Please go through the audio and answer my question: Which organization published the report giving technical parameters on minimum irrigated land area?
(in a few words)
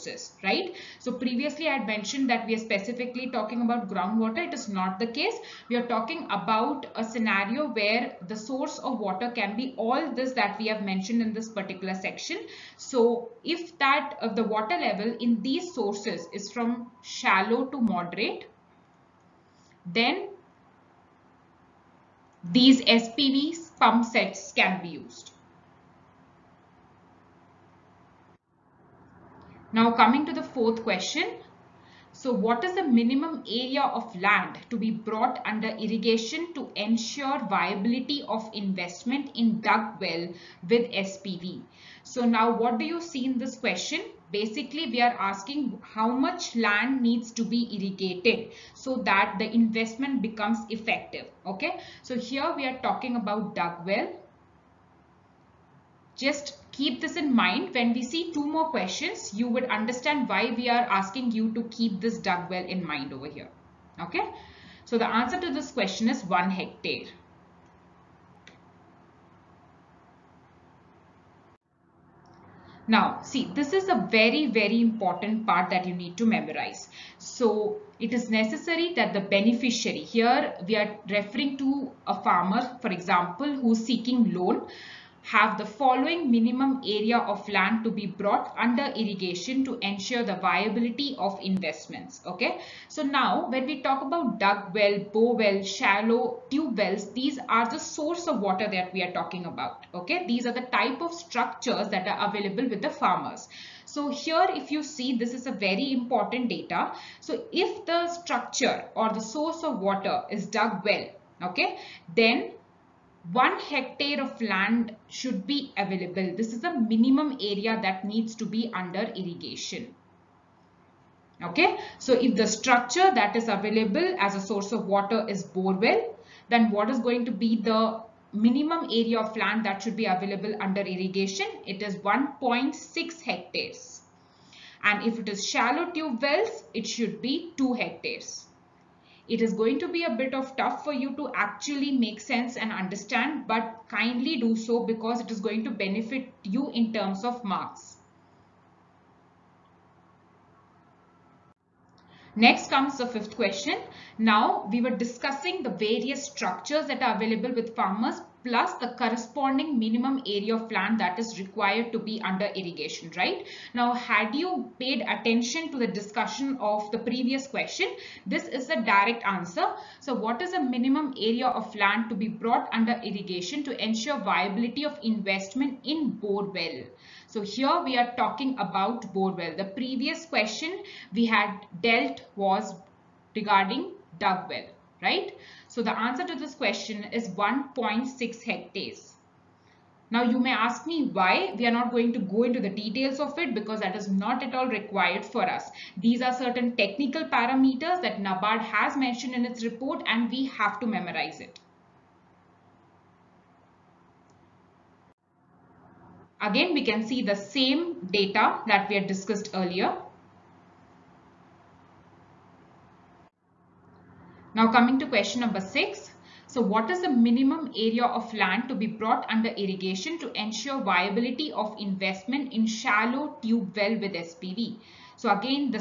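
NABARD.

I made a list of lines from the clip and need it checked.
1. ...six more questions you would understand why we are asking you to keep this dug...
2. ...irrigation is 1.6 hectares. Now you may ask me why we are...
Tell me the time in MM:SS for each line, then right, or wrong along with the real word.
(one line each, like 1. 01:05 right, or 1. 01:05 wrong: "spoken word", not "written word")
1. 00:58 wrong: "two", not "six"
2. 03:06 wrong: "question", not "irrigation".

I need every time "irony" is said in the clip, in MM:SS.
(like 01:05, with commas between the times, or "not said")
not said.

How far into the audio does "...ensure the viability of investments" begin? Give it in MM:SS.
01:29.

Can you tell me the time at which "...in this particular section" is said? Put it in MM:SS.
00:11.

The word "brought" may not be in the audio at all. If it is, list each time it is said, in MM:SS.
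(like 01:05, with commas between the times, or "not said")
00:34, 01:28, 02:52, 03:38.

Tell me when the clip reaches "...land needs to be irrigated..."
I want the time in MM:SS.
00:46.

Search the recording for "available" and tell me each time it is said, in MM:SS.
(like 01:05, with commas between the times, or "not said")
01:42, 01:55, 02:03, 02:10, 02:37.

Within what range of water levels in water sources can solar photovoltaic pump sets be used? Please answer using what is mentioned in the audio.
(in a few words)
shallow to moderate.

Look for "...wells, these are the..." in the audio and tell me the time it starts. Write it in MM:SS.
01:36.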